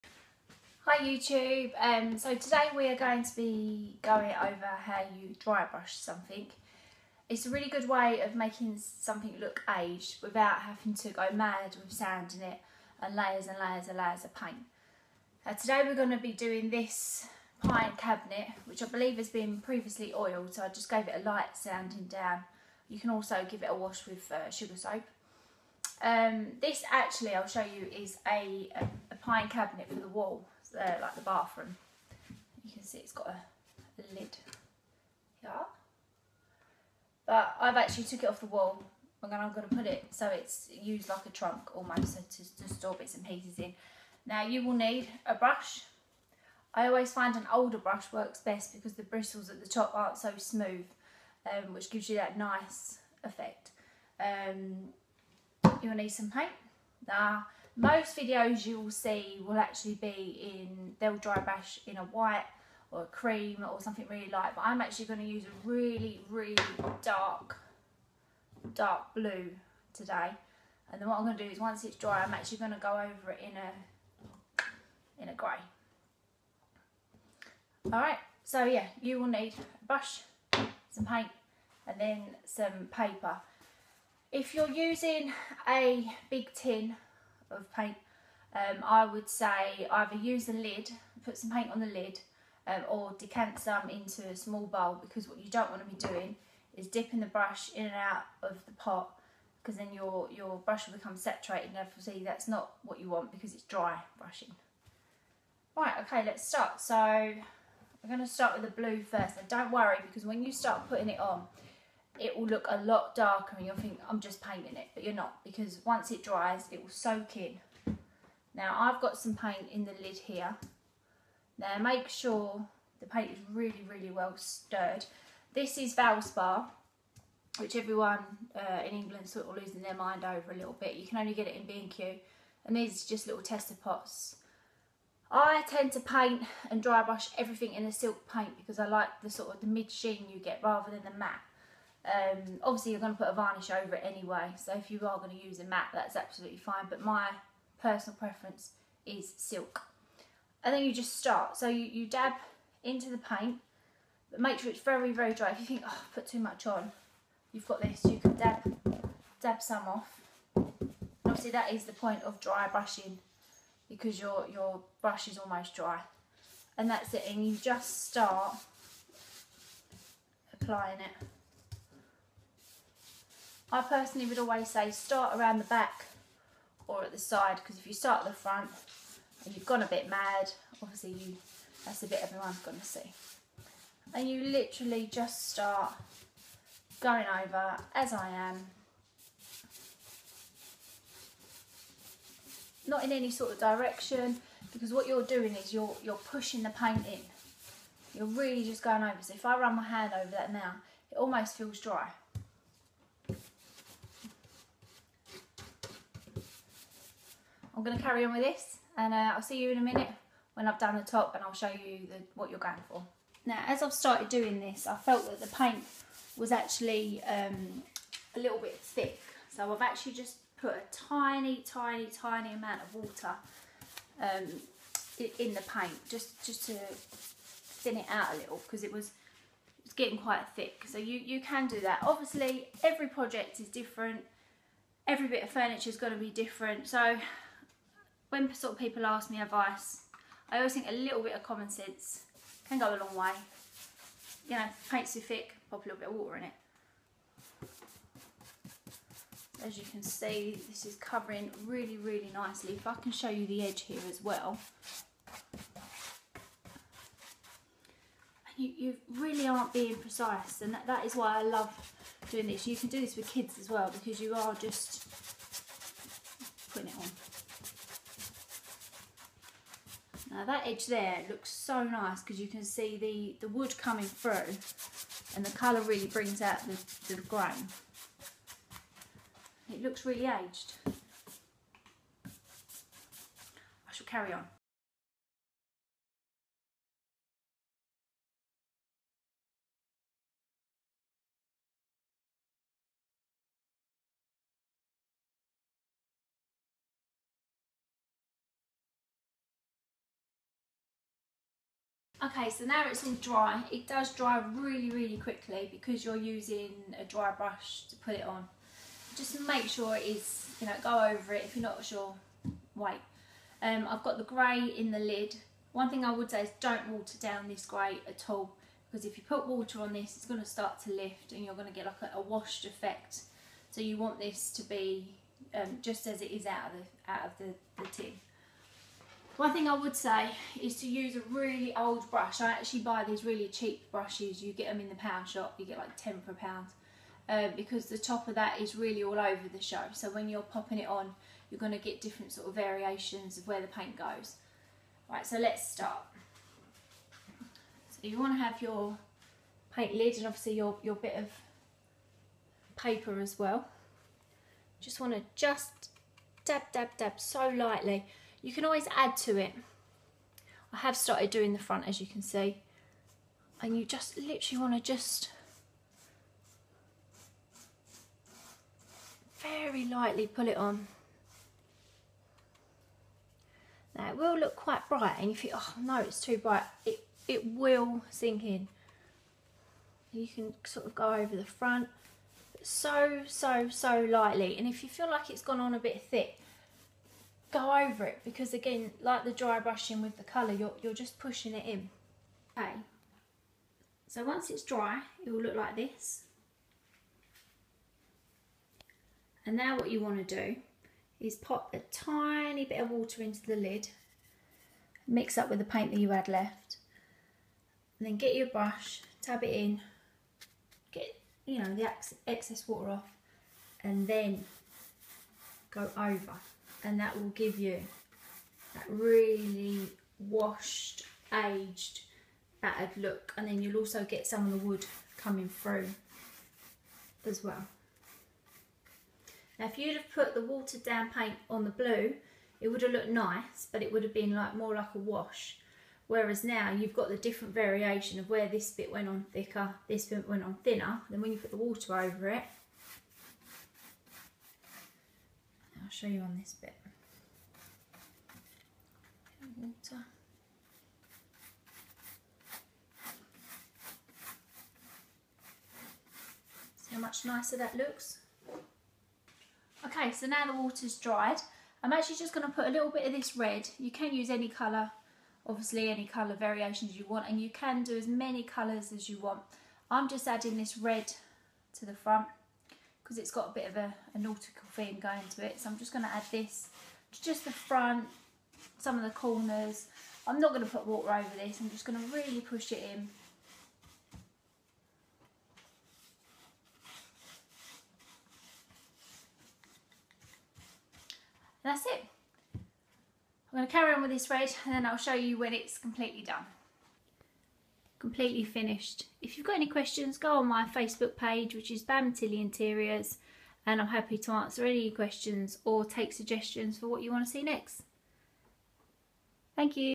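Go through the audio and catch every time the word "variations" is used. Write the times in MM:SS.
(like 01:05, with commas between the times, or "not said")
05:42, 07:17, 07:46.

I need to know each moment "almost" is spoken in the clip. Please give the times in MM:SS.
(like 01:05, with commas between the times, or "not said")
00:41, 02:45, 03:21.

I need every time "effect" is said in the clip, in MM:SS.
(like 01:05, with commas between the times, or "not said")
00:53, 05:22.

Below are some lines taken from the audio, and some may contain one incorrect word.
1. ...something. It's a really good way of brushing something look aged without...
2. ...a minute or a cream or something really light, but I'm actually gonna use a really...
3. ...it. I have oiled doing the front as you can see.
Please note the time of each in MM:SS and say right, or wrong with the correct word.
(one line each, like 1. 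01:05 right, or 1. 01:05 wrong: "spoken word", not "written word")
1. 00:05 wrong: "making", not "brushing"
2. 01:01 wrong: "white", not "minute"
3. 05:59 wrong: "started", not "oiled".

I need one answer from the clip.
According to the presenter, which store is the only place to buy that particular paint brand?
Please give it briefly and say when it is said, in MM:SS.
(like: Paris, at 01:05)
B&Q, at 02:11.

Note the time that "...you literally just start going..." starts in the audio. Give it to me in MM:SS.
03:04.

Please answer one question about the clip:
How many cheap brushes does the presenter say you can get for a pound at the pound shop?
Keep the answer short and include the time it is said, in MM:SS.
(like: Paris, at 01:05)
10, at 05:35.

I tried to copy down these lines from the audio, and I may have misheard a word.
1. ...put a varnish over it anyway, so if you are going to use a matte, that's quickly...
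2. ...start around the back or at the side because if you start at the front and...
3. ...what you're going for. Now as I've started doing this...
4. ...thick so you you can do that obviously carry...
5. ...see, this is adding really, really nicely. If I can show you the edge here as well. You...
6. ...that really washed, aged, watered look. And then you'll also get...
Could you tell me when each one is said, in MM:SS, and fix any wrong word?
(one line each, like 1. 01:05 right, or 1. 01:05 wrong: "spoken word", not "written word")
1. 02:23 wrong: "absolutely", not "quickly"
2. 02:54 right
3. 03:32 right
4. 03:50 wrong: "every", not "carry"
5. 04:10 wrong: "covering", not "adding"
6. 06:58 wrong: "battered", not "watered".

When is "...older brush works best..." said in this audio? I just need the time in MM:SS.
00:47.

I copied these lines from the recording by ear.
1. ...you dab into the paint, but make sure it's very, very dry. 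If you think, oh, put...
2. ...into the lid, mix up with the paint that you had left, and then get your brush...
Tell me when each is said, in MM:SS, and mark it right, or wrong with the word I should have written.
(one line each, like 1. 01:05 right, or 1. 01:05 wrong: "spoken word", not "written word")
1. 02:31 right
2. 06:43 right.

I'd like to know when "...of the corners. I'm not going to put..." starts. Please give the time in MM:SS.
07:58.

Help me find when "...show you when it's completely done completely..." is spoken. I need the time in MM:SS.
08:14.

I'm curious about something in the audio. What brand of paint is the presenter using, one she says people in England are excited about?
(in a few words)
Valspar.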